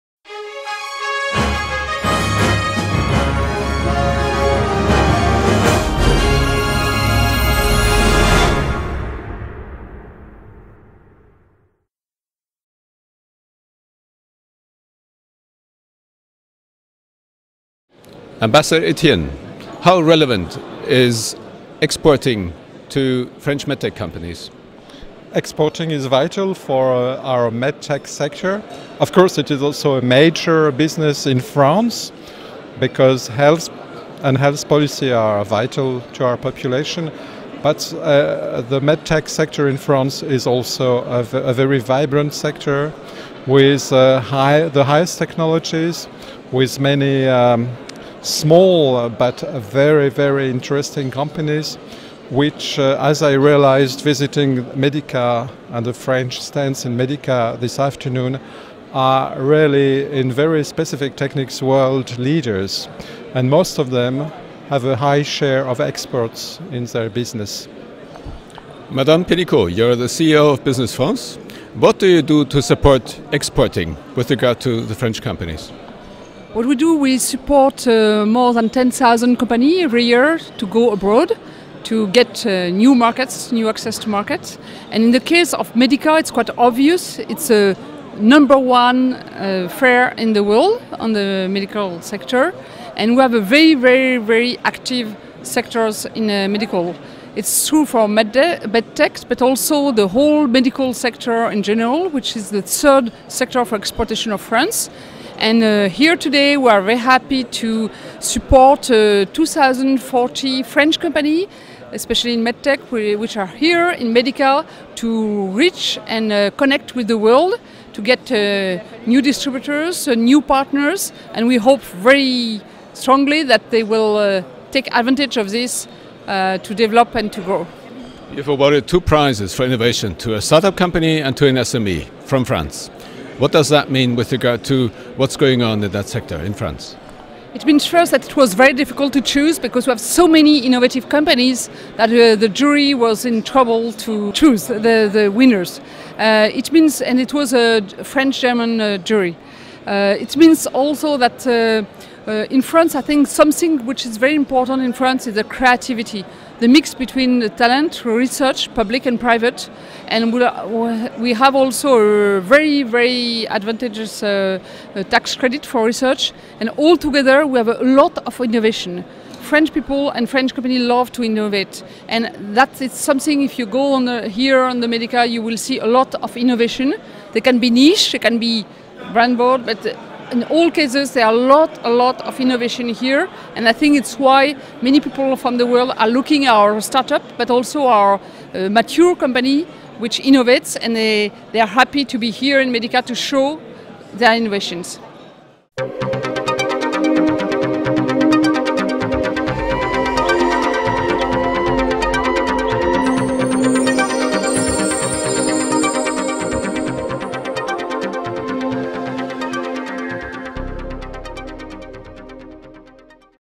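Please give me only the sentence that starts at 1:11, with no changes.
What do you do to support exporting with regard to the French companies?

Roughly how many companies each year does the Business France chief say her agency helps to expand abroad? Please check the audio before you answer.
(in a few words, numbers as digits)
more than 10,000.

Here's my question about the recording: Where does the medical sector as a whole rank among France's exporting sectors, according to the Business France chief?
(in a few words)
third.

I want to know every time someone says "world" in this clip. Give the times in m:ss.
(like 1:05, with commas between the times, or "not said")
1:01, 1:30, 1:57, 3:05.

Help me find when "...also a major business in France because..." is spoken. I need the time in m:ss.
0:29.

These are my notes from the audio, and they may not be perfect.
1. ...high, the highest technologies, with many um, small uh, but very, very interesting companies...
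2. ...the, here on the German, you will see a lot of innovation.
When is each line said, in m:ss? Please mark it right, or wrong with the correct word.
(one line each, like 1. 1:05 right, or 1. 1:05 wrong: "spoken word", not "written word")
1. 0:44 right
2. 2:54 wrong: "Medica", not "German".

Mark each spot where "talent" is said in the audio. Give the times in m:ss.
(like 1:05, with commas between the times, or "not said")
2:37.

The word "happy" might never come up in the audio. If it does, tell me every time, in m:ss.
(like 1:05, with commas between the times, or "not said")
1:46, 3:11.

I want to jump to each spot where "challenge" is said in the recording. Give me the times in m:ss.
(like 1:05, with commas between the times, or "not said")
not said.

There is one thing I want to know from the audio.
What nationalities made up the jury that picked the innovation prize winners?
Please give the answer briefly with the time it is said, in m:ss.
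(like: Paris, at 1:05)
French German, at 2:28.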